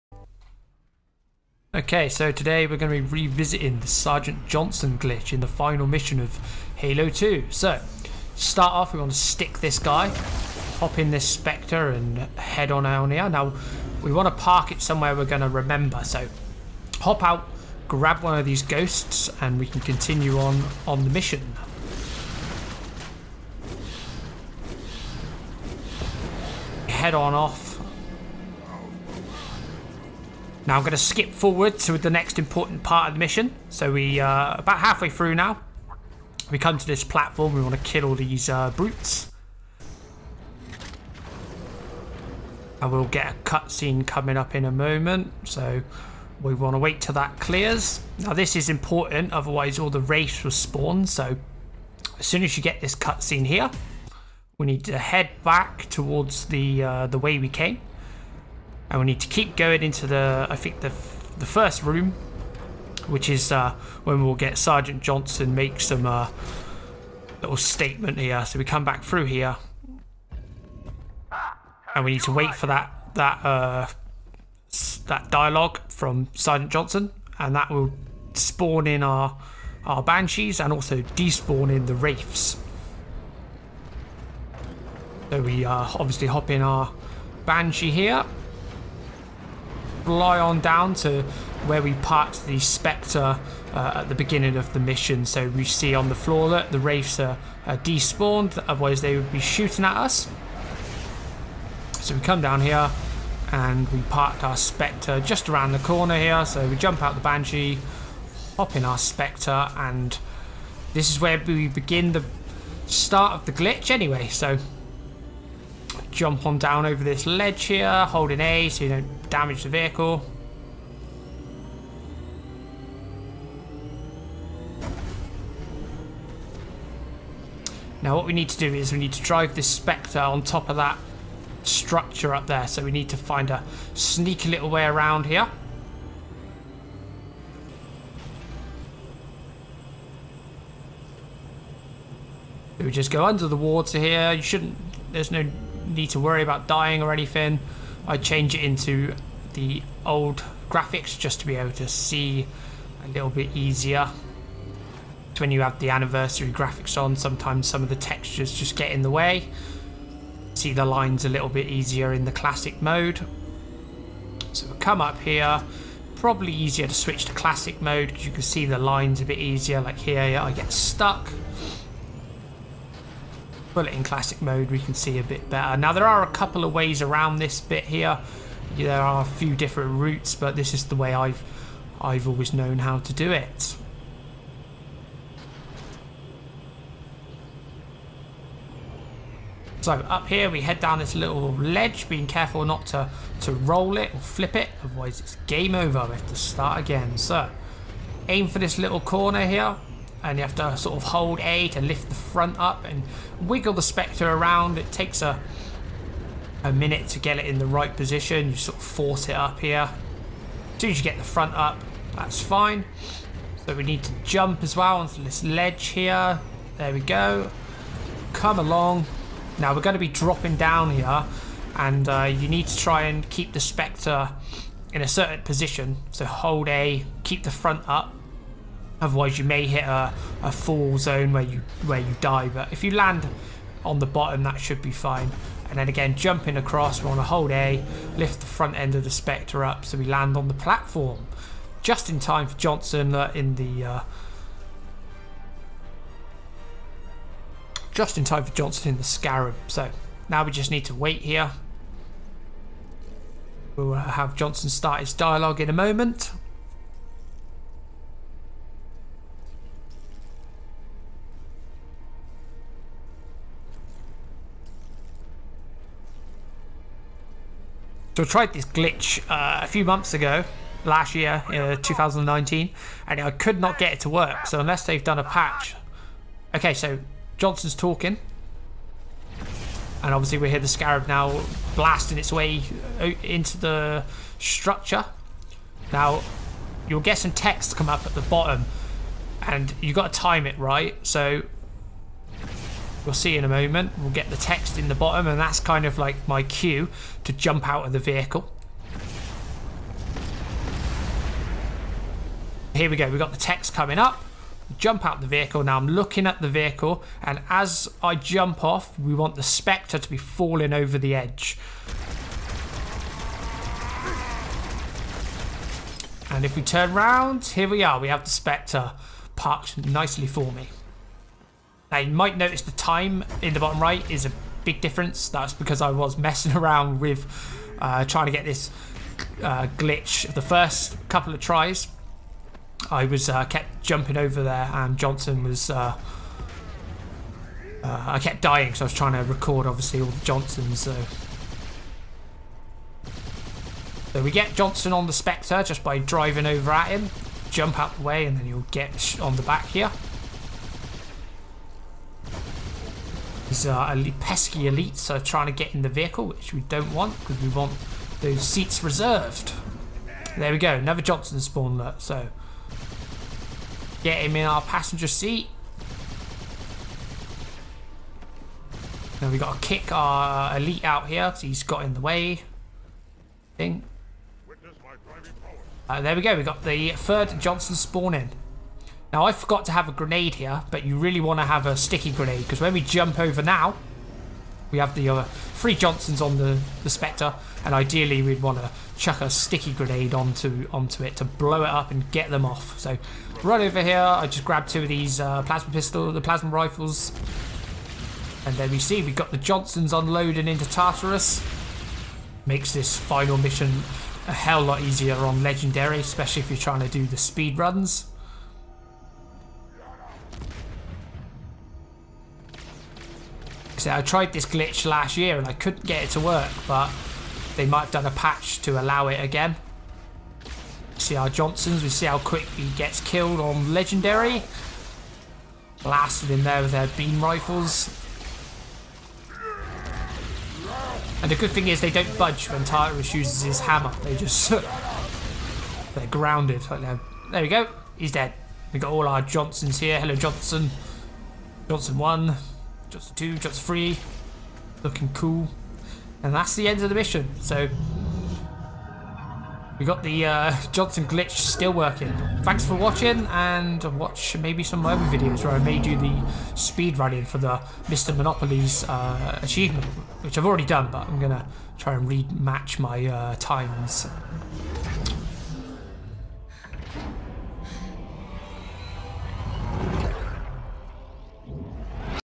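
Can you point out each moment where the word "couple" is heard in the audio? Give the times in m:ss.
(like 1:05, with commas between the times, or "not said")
2:56, 5:31.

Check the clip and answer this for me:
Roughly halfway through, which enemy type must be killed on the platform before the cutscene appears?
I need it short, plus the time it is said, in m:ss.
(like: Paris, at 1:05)
Brutes, at 0:38.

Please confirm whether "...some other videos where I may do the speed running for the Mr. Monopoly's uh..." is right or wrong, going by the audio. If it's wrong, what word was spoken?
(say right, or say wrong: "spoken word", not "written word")
right.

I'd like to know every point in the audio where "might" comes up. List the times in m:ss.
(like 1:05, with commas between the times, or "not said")
5:22, 6:57.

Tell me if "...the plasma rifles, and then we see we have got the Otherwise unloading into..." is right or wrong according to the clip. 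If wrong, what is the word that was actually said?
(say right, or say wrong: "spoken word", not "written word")
wrong: "Johnsons", not "Otherwise".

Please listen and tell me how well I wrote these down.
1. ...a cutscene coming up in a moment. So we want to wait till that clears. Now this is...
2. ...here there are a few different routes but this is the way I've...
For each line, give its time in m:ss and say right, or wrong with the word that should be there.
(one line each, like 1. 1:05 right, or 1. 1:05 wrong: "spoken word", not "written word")
1. 0:43 right
2. 2:57 right.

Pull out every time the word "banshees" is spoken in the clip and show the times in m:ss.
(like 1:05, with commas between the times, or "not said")
1:20, 1:27, 1:47.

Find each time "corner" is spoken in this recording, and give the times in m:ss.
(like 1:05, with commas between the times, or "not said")
1:45, 3:18.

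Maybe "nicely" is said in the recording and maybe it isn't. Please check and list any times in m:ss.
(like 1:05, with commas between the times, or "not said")
5:19.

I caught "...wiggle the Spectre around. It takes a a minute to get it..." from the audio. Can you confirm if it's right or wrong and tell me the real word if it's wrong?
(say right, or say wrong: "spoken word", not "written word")
right.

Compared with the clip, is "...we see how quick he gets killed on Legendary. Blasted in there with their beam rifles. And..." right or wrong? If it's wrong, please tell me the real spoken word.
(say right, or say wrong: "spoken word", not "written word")
right.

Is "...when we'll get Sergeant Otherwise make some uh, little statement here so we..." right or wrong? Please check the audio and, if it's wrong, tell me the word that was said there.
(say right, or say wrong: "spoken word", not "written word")
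wrong: "Johnson", not "Otherwise".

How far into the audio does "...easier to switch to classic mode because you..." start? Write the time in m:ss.
2:46.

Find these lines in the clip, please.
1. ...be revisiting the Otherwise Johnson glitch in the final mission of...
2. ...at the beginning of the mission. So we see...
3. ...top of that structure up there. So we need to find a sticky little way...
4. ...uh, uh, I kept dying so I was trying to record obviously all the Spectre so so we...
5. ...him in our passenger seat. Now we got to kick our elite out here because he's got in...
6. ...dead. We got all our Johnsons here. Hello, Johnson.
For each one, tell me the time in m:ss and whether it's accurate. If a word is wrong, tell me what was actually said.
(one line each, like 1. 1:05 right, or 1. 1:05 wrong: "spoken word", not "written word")
1. 0:03 wrong: "Sergeant", not "Otherwise"
2. 1:33 right
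3. 2:10 wrong: "sneaky", not "sticky"
4. 5:35 wrong: "Johnsons", not "Spectre"
5. 6:04 right
6. 7:18 right.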